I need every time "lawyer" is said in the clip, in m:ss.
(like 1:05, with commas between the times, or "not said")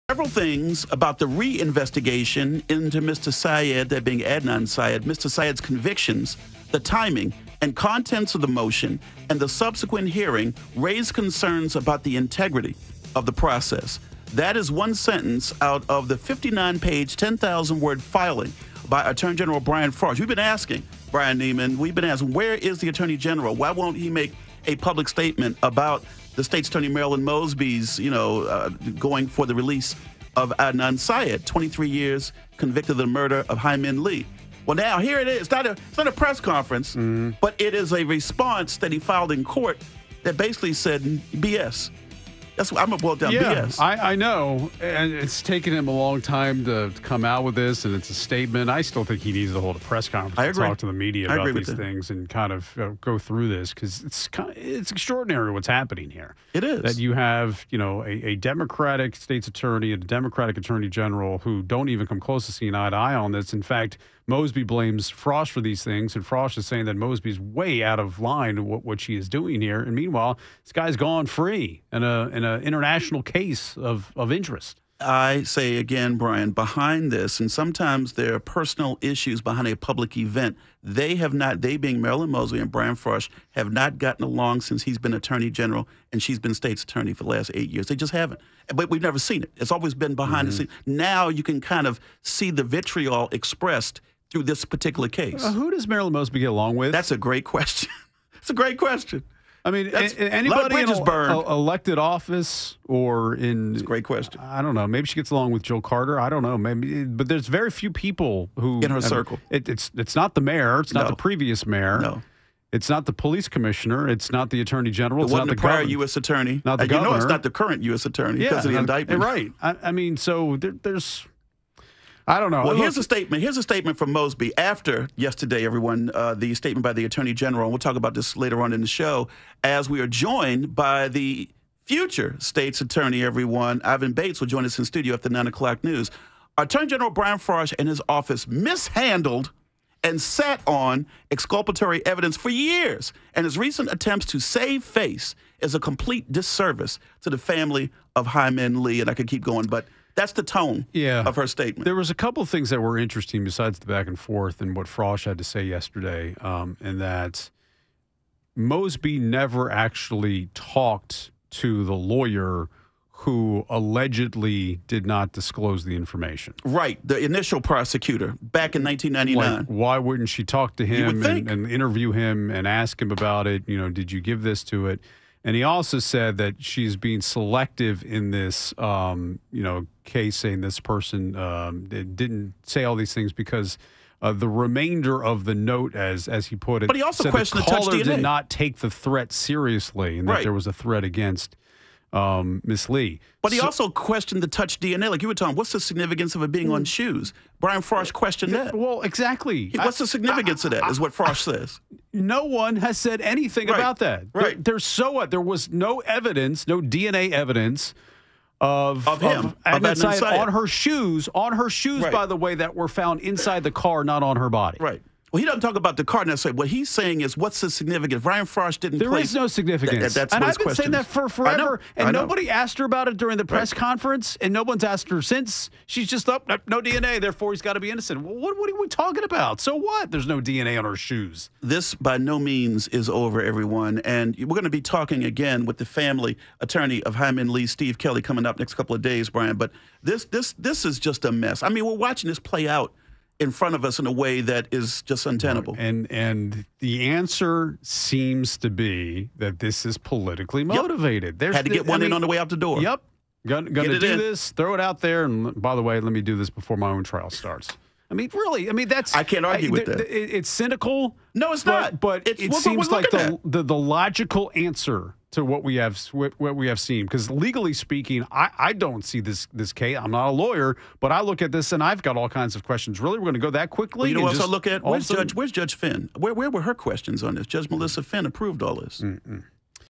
2:41, 4:30.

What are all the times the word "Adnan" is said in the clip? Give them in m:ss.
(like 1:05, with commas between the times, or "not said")
0:04, 0:30, 3:29.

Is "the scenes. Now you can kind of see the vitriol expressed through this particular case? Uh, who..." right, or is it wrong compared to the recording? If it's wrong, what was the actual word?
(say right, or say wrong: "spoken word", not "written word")
right.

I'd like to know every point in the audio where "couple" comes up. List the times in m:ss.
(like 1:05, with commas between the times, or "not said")
2:32, 3:58.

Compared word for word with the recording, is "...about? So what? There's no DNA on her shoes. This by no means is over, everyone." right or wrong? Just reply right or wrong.
right.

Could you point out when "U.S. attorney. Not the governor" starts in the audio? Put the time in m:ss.
1:55.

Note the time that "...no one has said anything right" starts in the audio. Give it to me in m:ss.
3:22.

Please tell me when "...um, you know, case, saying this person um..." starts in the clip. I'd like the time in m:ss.
2:58.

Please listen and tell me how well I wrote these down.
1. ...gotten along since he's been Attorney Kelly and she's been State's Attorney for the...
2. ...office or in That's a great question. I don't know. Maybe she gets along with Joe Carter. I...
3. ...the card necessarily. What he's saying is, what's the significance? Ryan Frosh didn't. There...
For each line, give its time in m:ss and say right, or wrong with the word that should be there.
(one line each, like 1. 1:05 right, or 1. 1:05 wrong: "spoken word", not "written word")
1. 1:23 wrong: "General", not "Kelly"
2. 1:41 right
3. 3:35 right.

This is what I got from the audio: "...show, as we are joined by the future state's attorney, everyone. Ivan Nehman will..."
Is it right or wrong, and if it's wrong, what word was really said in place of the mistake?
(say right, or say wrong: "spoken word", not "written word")
wrong: "Bates", not "Nehman".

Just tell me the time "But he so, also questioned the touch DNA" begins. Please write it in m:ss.
3:13.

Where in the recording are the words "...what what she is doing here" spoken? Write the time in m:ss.
1:08.